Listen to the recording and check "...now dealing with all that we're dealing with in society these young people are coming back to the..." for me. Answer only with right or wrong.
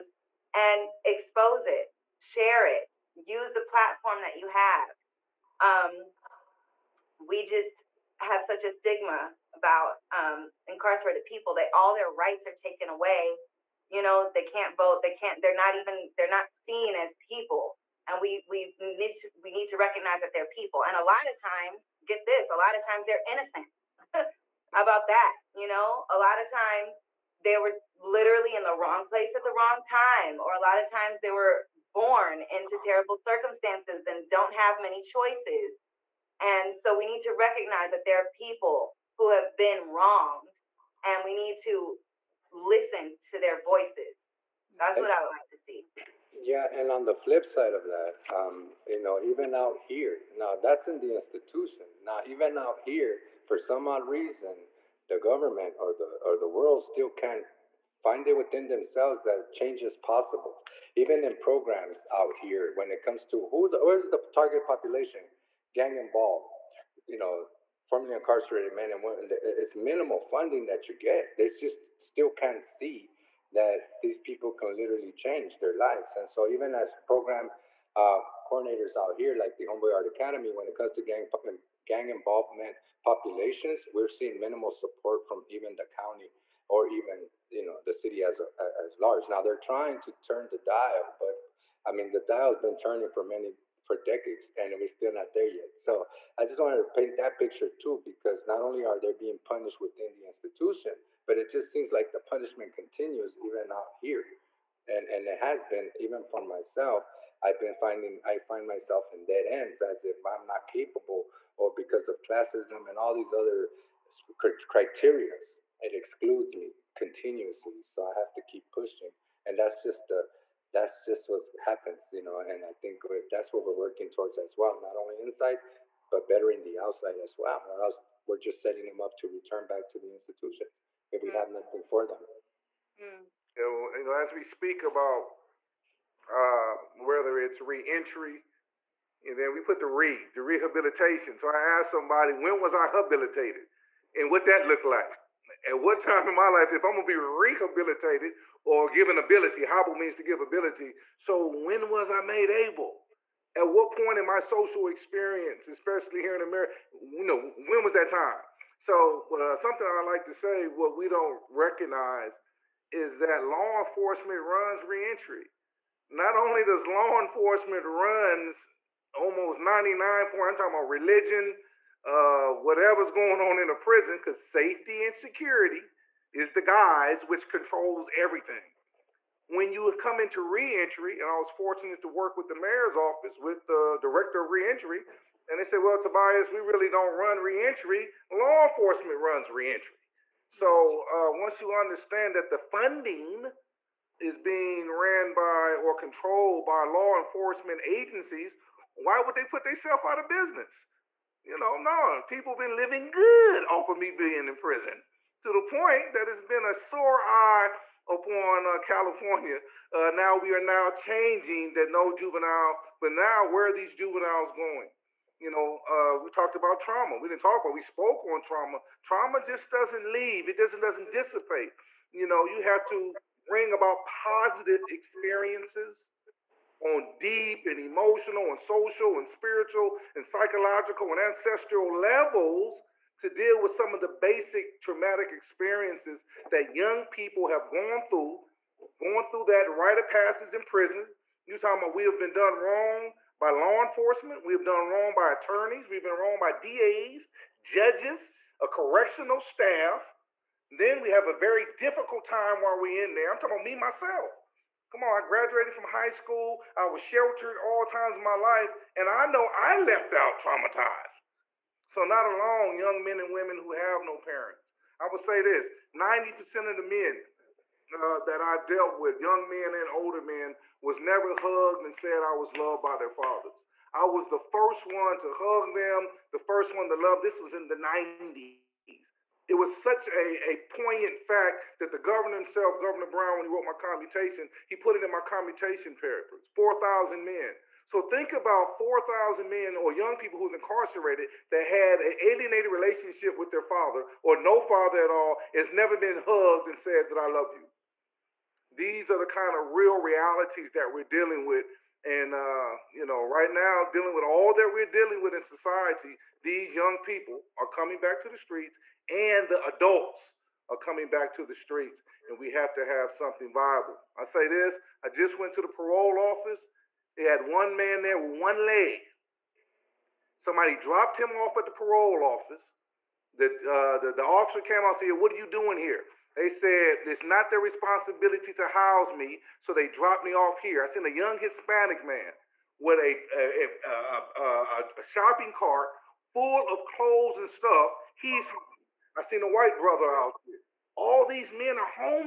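right.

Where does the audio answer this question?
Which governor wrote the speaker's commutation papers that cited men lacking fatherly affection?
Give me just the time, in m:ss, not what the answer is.
4:42.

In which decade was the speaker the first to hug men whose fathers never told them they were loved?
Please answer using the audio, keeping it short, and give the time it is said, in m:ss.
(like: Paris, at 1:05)
The 90s, at 4:37.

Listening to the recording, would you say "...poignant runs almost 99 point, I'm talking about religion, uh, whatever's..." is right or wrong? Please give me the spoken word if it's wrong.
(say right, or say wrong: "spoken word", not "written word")
wrong: "enforcement", not "poignant".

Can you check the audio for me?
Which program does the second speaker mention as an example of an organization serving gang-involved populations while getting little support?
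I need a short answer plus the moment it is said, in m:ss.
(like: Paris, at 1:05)
Homeboy Art Academy, at 1:19.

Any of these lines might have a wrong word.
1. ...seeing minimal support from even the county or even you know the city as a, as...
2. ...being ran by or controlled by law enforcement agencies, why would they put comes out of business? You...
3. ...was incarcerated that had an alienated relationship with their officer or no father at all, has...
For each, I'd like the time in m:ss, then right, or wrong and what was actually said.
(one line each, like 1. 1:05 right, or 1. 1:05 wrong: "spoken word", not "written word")
1. 1:24 right
2. 3:14 wrong: "themselves", not "comes"
3. 4:50 wrong: "father", not "officer".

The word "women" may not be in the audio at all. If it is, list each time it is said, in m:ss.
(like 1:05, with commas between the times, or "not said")
1:09, 4:23.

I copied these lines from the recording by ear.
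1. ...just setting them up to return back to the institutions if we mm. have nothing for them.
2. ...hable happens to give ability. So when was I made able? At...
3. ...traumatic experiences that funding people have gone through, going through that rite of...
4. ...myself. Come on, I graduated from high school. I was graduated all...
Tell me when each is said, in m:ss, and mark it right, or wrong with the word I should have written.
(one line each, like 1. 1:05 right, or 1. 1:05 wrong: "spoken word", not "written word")
1. 2:08 right
2. 2:29 wrong: "means", not "happens"
3. 3:54 wrong: "young", not "funding"
4. 4:13 wrong: "sheltered", not "graduated".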